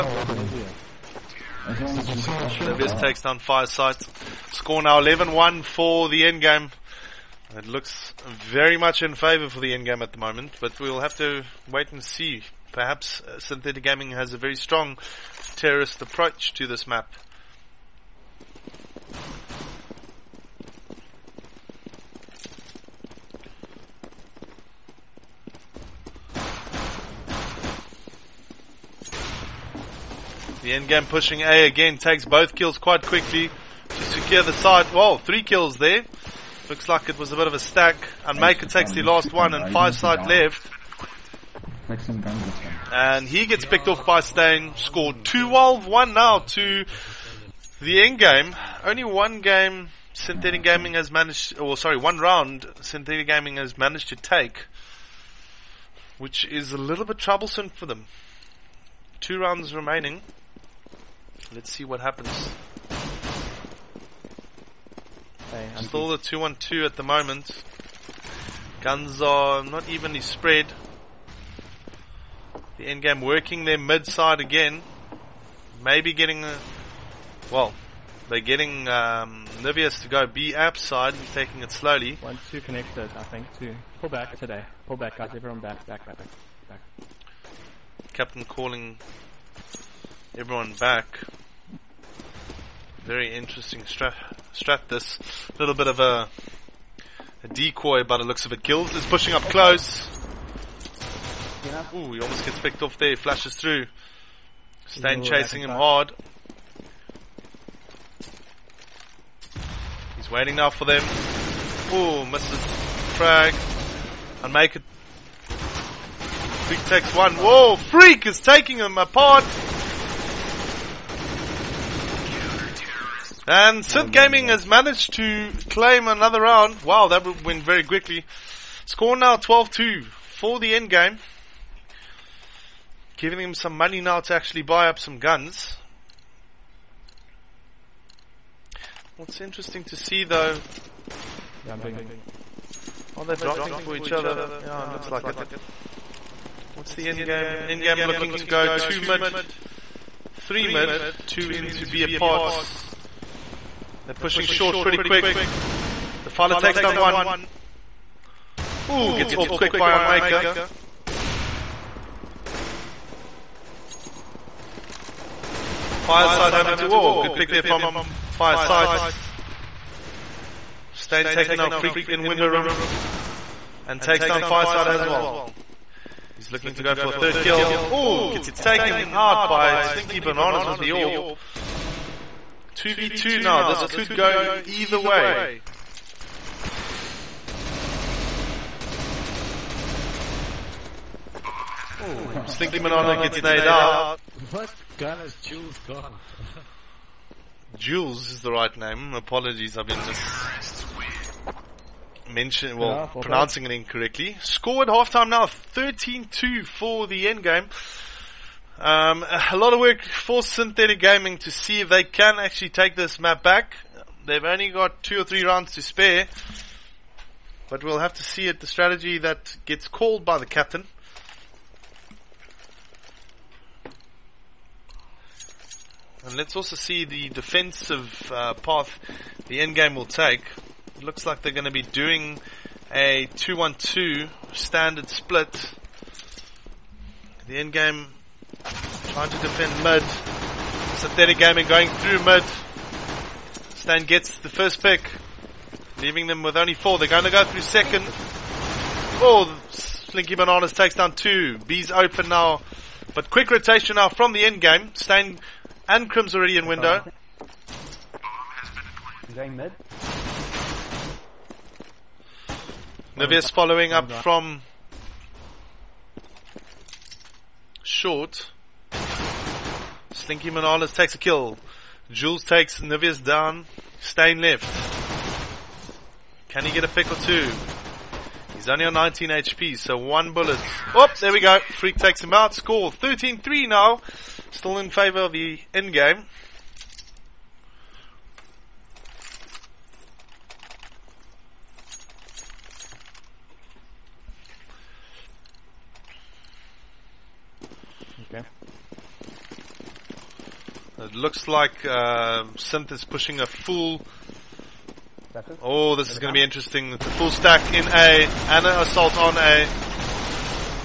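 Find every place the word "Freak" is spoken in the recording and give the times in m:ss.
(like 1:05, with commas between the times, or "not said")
1:57, 2:51, 4:41.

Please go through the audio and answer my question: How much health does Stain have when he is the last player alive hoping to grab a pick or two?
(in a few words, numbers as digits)
19 HP.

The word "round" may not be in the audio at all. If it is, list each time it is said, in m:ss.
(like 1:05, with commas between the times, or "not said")
0:52, 0:59, 2:06, 3:35.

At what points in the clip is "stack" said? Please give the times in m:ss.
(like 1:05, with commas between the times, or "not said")
0:37, 5:07.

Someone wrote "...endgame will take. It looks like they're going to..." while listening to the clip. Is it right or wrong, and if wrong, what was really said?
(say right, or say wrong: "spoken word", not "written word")
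right.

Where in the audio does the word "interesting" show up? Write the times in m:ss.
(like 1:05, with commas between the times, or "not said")
1:33, 2:19, 5:06.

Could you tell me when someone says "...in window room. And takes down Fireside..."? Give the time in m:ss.
2:52.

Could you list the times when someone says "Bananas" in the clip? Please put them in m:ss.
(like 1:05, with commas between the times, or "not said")
3:00, 4:10.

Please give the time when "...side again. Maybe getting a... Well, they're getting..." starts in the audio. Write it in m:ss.
1:14.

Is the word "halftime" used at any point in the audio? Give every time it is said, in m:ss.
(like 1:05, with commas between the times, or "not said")
3:24.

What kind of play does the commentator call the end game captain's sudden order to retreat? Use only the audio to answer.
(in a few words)
A decoy.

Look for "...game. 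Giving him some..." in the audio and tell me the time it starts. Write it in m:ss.
2:10.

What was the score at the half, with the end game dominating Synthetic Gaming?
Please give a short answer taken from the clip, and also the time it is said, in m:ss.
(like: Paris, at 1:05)
13-2, at 3:25.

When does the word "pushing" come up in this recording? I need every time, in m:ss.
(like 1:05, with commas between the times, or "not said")
0:31, 1:39, 2:34, 5:03.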